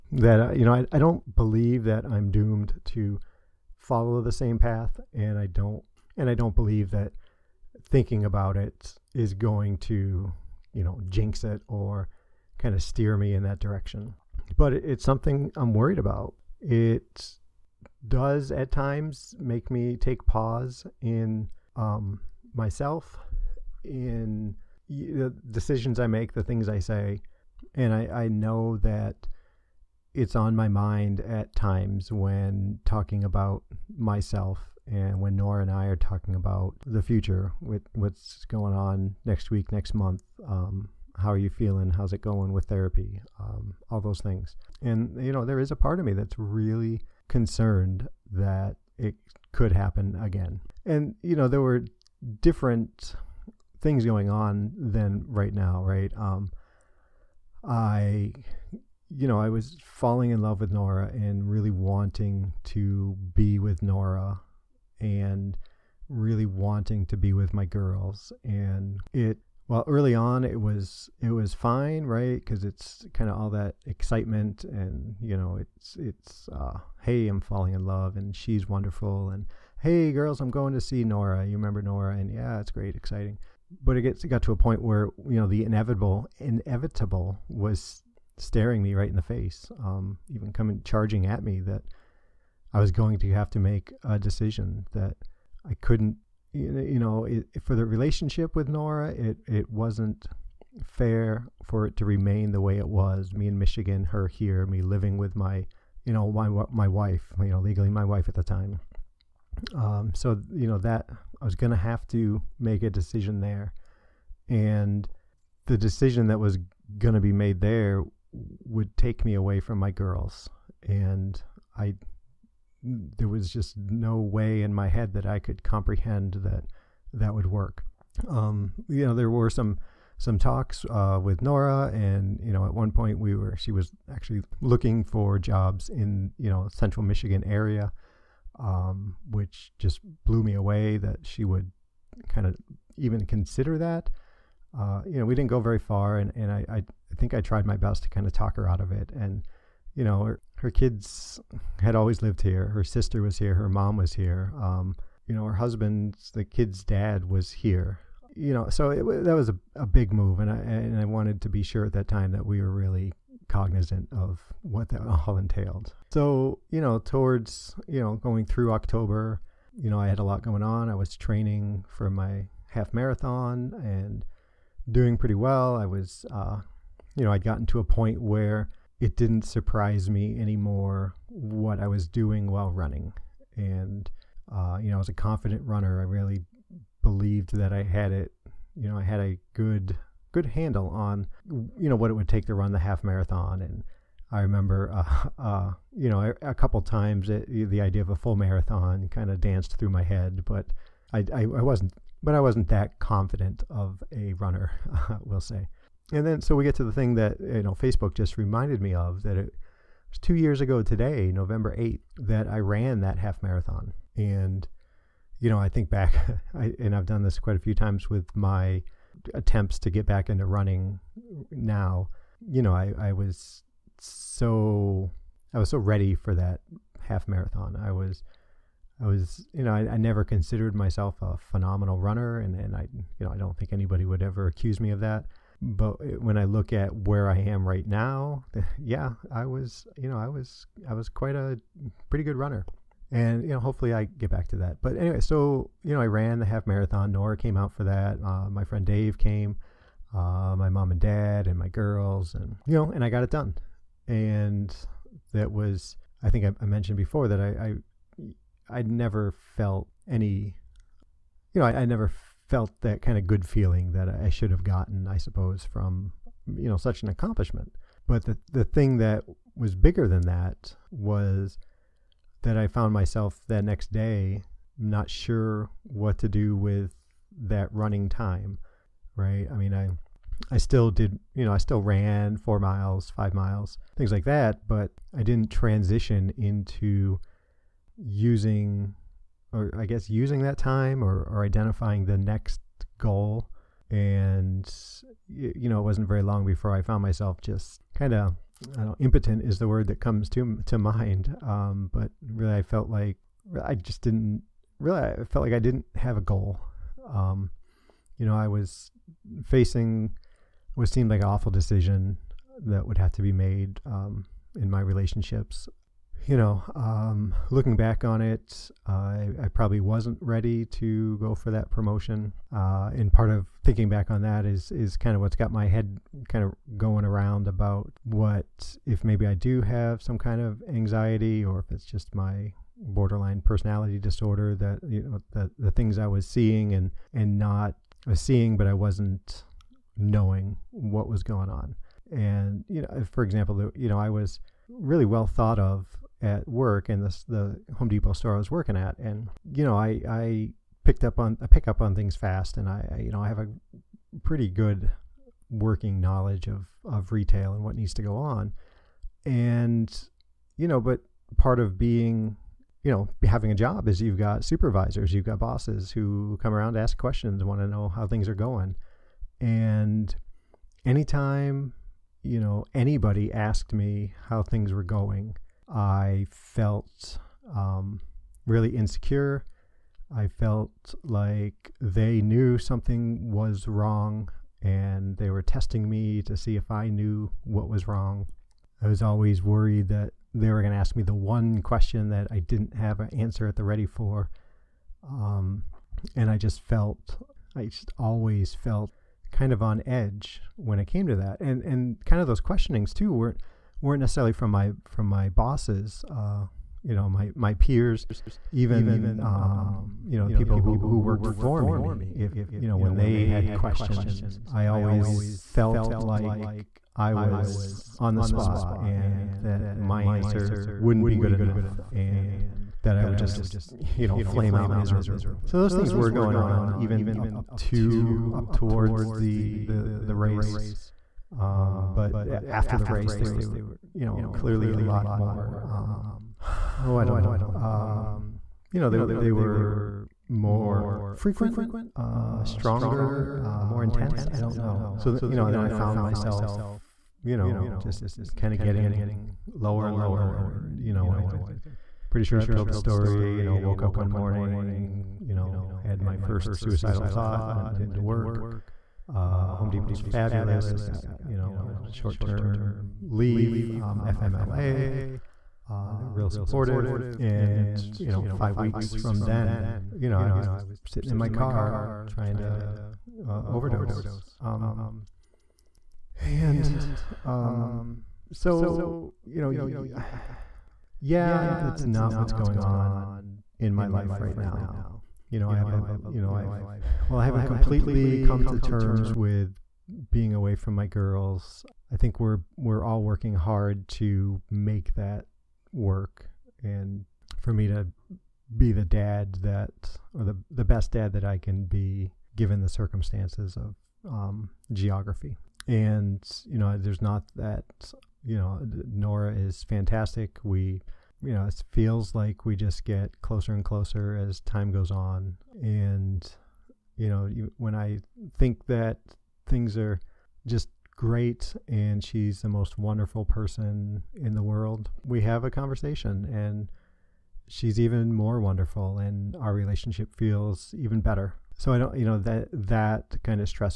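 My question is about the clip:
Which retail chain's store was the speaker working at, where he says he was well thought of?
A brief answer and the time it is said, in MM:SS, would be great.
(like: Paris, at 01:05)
Home Depot, at 05:47.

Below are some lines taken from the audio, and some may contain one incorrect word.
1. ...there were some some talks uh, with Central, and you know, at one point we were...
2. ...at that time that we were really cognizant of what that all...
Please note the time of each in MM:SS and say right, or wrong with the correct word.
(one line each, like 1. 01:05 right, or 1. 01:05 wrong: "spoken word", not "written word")
1. 02:09 wrong: "Nora", not "Central"
2. 02:41 right.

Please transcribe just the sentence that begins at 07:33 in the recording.
You know, woke up one morning, you know, had my first suicidal thought, went into work, uh, Home is fabulous.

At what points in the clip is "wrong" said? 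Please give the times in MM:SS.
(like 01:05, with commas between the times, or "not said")
06:23, 06:27.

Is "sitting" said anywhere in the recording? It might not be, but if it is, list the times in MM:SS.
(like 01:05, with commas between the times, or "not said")
07:50.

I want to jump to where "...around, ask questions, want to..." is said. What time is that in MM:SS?
06:06.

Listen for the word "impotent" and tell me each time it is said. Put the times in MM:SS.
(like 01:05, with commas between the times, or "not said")
04:58.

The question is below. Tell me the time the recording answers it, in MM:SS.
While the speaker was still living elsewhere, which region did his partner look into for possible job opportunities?
02:16.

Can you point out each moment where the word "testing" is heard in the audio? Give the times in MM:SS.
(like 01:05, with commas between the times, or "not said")
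06:25.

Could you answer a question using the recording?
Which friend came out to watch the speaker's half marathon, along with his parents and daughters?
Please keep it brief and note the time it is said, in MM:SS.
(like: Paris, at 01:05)
Dave, at 04:08.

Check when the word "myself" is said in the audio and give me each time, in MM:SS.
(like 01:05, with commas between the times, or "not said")
00:22, 00:33, 03:50, 04:32, 04:57, 07:25.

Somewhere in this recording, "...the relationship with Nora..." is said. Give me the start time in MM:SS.
01:37.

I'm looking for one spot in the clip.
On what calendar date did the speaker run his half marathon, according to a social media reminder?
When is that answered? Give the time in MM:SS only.
03:31.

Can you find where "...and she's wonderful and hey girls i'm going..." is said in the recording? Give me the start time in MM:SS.
01:18.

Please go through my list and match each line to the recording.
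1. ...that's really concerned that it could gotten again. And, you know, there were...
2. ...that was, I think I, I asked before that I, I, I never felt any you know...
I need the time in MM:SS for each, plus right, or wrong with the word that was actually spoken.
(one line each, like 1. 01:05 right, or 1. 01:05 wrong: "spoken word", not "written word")
1. 00:46 wrong: "happen", not "gotten"
2. 04:15 wrong: "mentioned", not "asked".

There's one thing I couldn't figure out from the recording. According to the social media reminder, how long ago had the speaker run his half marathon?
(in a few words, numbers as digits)
two years.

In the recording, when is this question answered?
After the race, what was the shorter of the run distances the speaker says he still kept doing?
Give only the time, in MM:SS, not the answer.
04:42.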